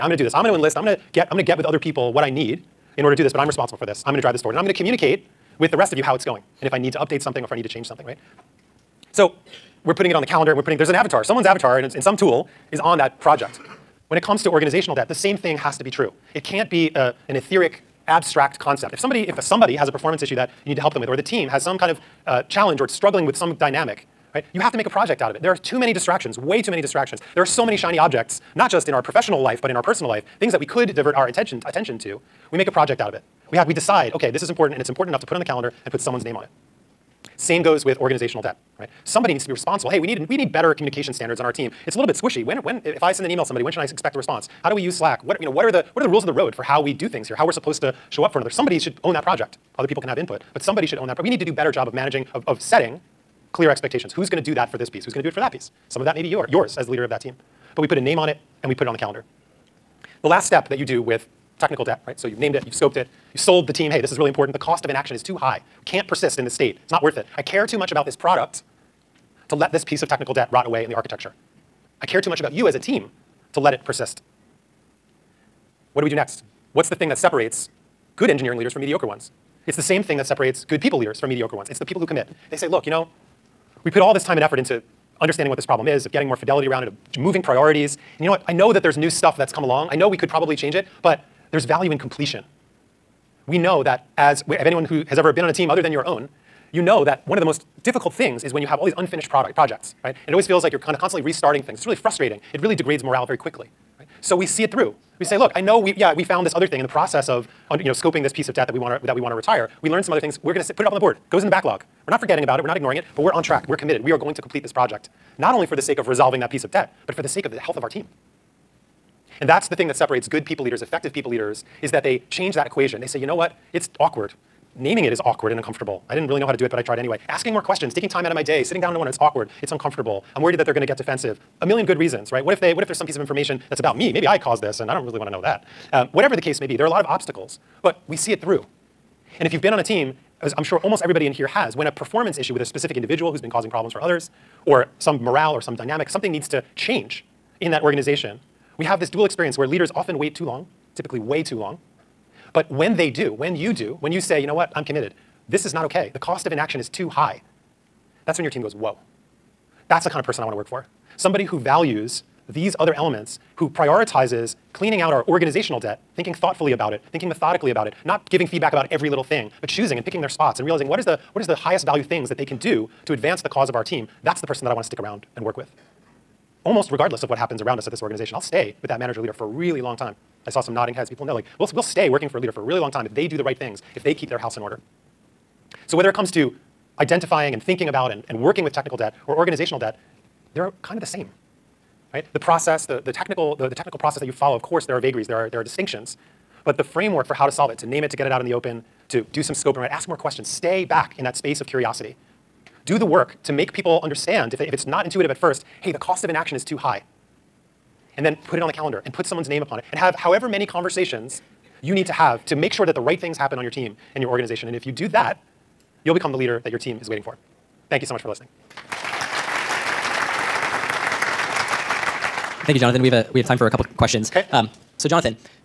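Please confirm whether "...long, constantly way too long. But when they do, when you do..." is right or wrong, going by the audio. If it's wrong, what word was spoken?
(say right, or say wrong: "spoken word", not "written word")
wrong: "typically", not "constantly".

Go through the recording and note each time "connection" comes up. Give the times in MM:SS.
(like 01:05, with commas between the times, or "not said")
not said.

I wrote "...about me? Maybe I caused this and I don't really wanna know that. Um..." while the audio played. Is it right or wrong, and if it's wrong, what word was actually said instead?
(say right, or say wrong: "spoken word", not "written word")
right.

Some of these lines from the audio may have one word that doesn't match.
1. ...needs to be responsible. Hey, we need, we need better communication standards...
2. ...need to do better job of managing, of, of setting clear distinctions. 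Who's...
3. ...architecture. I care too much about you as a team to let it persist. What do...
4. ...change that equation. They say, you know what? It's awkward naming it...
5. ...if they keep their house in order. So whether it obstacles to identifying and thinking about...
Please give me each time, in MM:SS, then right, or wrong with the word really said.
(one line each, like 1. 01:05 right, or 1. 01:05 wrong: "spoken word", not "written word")
1. 00:39 right
2. 00:51 wrong: "expectations", not "distinctions"
3. 01:10 right
4. 02:02 right
5. 03:03 wrong: "comes", not "obstacles".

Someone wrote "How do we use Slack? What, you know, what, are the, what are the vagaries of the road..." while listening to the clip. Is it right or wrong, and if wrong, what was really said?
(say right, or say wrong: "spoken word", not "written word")
wrong: "rules", not "vagaries".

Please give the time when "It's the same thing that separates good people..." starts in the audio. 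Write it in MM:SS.
01:19.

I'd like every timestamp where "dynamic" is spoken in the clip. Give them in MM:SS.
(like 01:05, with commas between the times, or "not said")
00:23, 02:25.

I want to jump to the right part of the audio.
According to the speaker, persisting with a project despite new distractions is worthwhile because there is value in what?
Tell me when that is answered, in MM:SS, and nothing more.
01:31.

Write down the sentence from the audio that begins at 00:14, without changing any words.
When it comes to organizational debt, the same thing has to be true.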